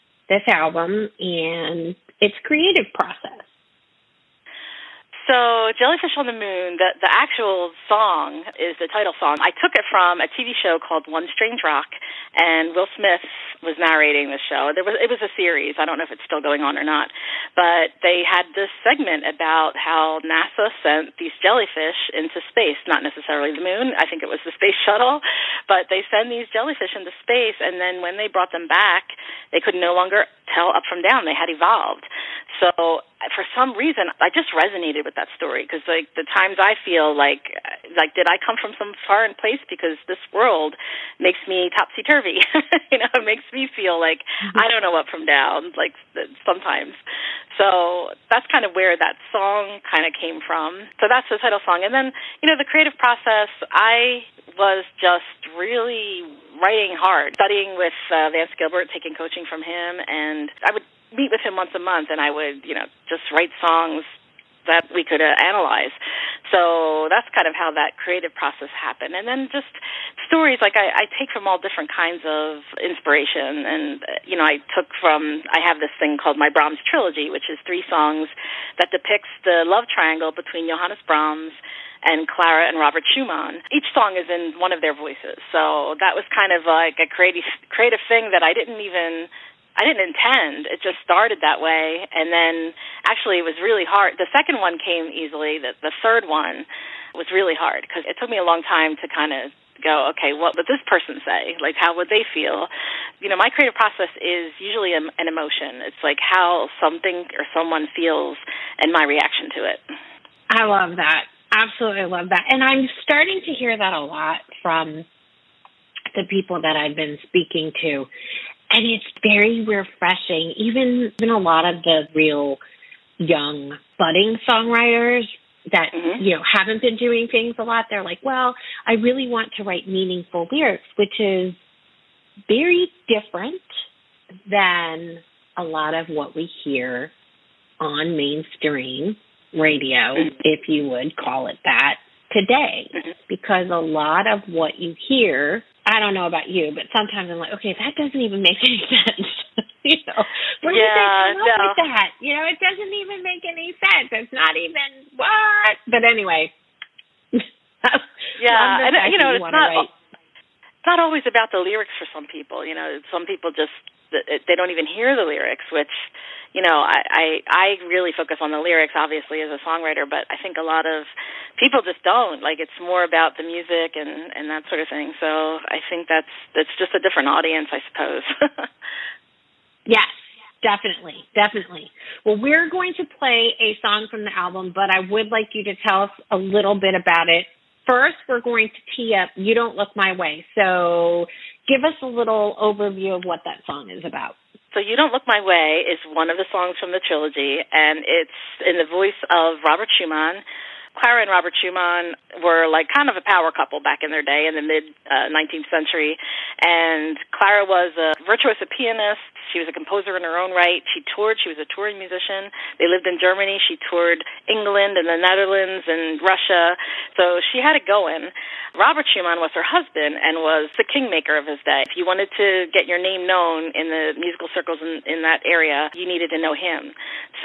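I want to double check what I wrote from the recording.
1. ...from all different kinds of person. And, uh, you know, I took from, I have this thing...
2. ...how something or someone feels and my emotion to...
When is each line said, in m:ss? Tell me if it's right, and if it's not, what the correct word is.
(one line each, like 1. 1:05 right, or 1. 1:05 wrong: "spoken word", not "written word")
1. 1:11 wrong: "inspiration", not "person"
2. 1:46 wrong: "reaction", not "emotion".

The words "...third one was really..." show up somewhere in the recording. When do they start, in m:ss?
1:36.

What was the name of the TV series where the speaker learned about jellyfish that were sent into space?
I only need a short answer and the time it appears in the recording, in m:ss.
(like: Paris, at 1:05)
One Strange Rock, at 0:11.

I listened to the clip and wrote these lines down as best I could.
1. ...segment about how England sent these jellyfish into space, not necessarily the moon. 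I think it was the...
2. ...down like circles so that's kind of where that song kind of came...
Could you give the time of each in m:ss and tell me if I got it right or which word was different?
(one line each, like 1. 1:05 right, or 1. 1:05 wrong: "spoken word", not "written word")
1. 0:18 wrong: "NASA", not "England"
2. 0:45 wrong: "sometimes", not "circles".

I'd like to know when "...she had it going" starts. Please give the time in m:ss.
3:37.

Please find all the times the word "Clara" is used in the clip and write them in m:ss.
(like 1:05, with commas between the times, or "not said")
1:22, 3:20, 3:27.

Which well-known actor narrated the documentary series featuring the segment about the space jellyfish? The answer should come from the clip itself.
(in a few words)
Will Smith.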